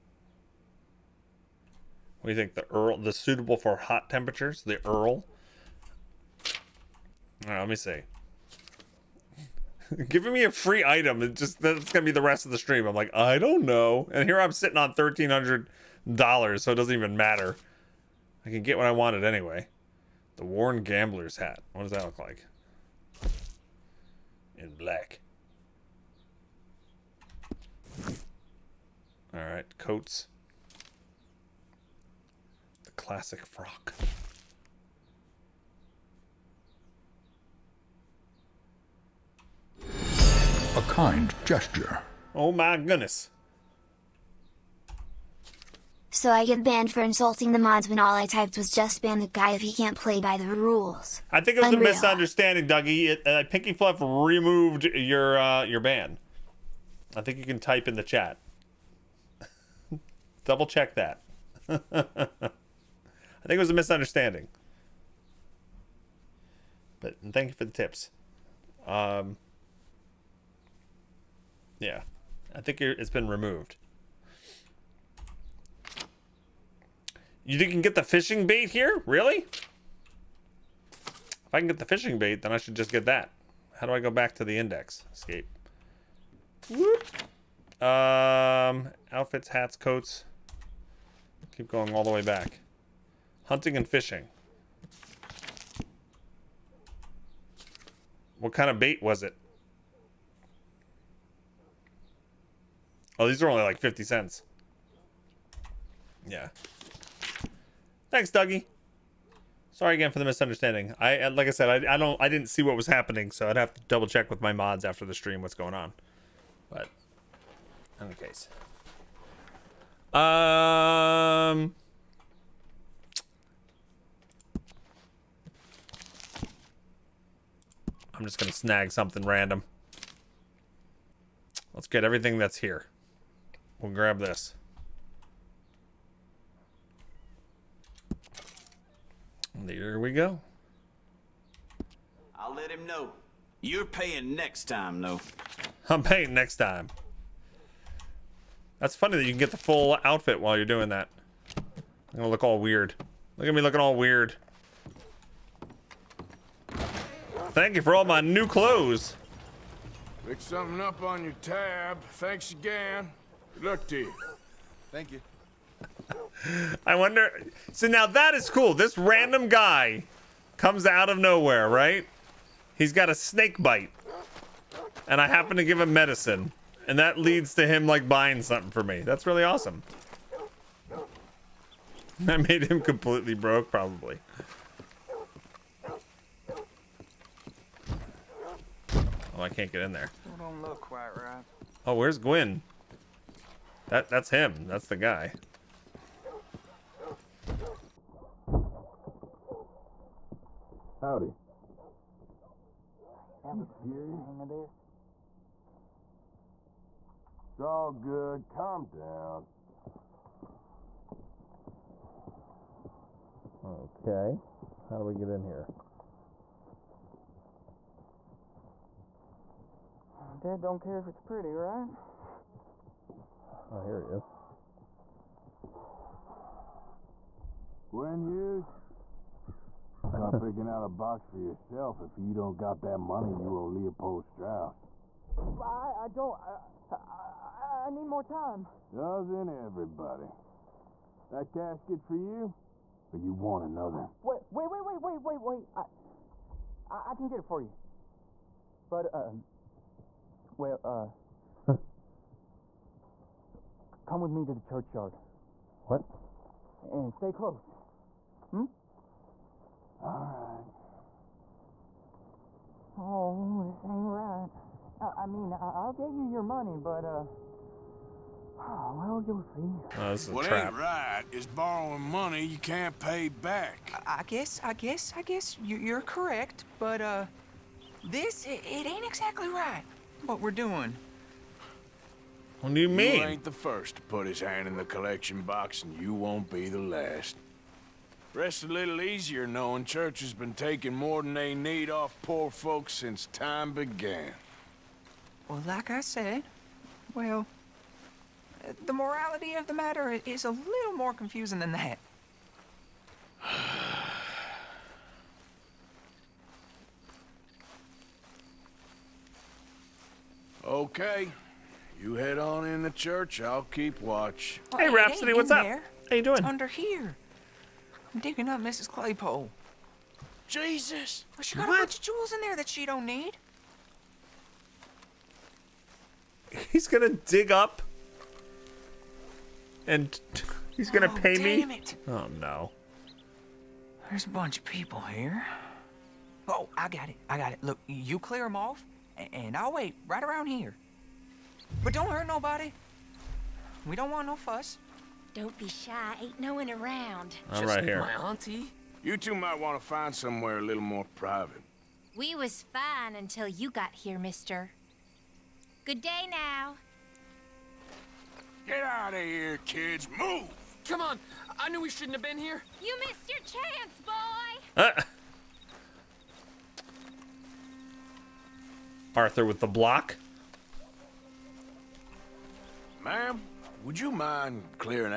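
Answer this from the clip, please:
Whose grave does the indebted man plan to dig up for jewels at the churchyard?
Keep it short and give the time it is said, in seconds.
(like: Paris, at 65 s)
Mrs. Claypole, at 318 s.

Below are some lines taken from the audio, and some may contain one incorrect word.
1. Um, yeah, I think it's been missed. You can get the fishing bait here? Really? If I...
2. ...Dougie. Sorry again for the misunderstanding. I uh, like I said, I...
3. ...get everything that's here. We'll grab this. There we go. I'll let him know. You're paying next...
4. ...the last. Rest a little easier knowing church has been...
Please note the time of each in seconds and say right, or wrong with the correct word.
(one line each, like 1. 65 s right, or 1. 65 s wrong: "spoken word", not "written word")
1. 68 s wrong: "removed", not "missed"
2. 108 s right
3. 131 s right
4. 286 s right.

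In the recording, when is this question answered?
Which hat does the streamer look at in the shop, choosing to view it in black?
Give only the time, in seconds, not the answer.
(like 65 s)
20 s.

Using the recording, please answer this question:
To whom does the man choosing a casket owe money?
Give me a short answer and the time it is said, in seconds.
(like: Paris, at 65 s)
Leopold Strauss, at 233 s.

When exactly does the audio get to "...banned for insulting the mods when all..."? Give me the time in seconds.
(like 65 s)
46 s.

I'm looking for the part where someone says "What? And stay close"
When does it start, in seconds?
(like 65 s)
255 s.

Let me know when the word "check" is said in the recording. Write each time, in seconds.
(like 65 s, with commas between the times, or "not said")
60 s, 114 s.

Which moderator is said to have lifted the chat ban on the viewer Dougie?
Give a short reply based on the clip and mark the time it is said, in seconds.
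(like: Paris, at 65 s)
Pinky Fluff, at 53 s.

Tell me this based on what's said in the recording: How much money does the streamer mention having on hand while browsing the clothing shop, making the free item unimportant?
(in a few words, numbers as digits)
$1300.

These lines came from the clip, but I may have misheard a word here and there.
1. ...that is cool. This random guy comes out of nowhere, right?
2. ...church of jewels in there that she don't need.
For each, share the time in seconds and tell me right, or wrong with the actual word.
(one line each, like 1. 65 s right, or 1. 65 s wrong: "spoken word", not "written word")
1. 168 s right
2. 321 s wrong: "bunch", not "church".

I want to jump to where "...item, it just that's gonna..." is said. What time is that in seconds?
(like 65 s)
10 s.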